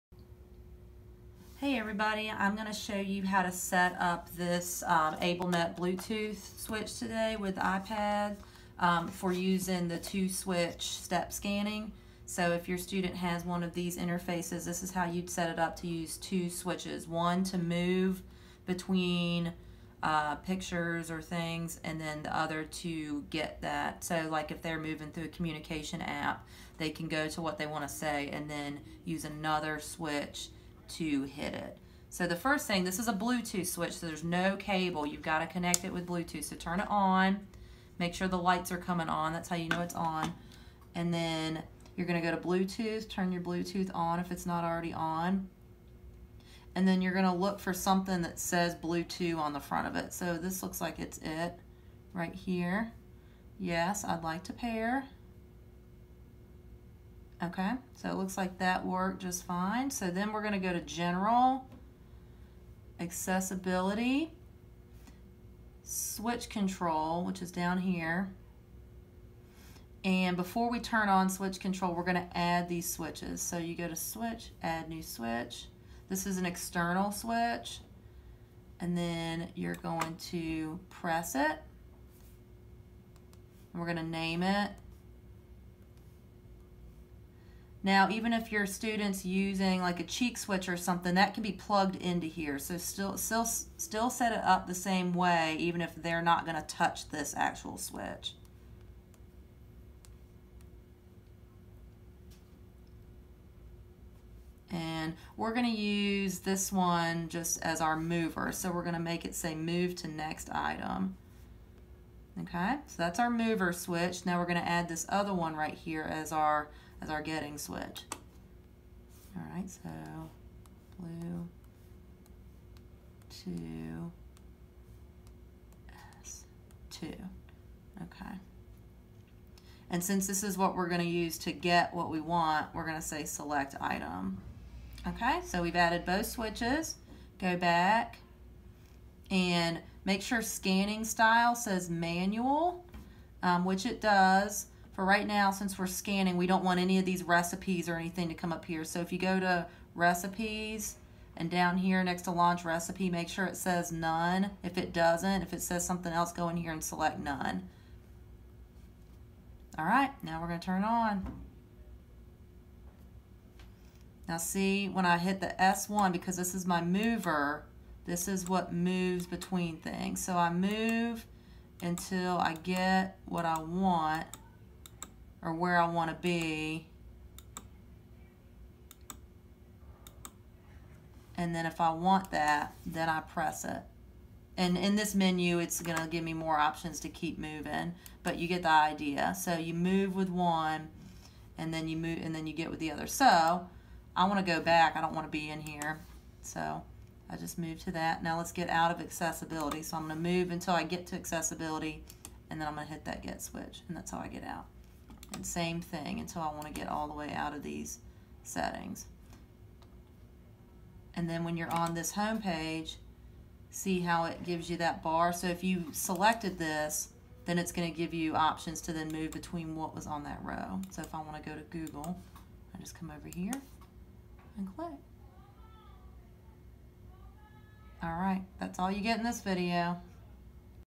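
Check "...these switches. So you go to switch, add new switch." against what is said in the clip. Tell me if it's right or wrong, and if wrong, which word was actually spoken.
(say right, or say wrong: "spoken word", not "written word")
right.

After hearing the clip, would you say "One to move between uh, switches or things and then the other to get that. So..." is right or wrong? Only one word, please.
wrong.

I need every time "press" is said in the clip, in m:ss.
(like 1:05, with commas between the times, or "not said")
1:20, 3:03.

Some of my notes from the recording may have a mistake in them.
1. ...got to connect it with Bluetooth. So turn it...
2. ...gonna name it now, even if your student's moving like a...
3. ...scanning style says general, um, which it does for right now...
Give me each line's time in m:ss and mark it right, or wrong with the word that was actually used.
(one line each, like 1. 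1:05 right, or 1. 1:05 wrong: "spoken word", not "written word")
1. 0:35 right
2. 1:23 wrong: "using", not "moving"
3. 2:20 wrong: "manual", not "general".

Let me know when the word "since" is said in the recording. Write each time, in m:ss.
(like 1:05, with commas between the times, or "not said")
2:10, 2:25.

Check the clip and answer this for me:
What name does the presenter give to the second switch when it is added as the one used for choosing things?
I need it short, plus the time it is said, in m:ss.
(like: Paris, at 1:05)
S2, at 2:06.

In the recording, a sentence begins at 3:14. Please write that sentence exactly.
I don't want to be in here.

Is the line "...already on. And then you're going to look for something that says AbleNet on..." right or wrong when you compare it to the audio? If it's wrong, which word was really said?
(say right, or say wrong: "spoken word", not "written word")
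wrong: "Bluetooth", not "AbleNet".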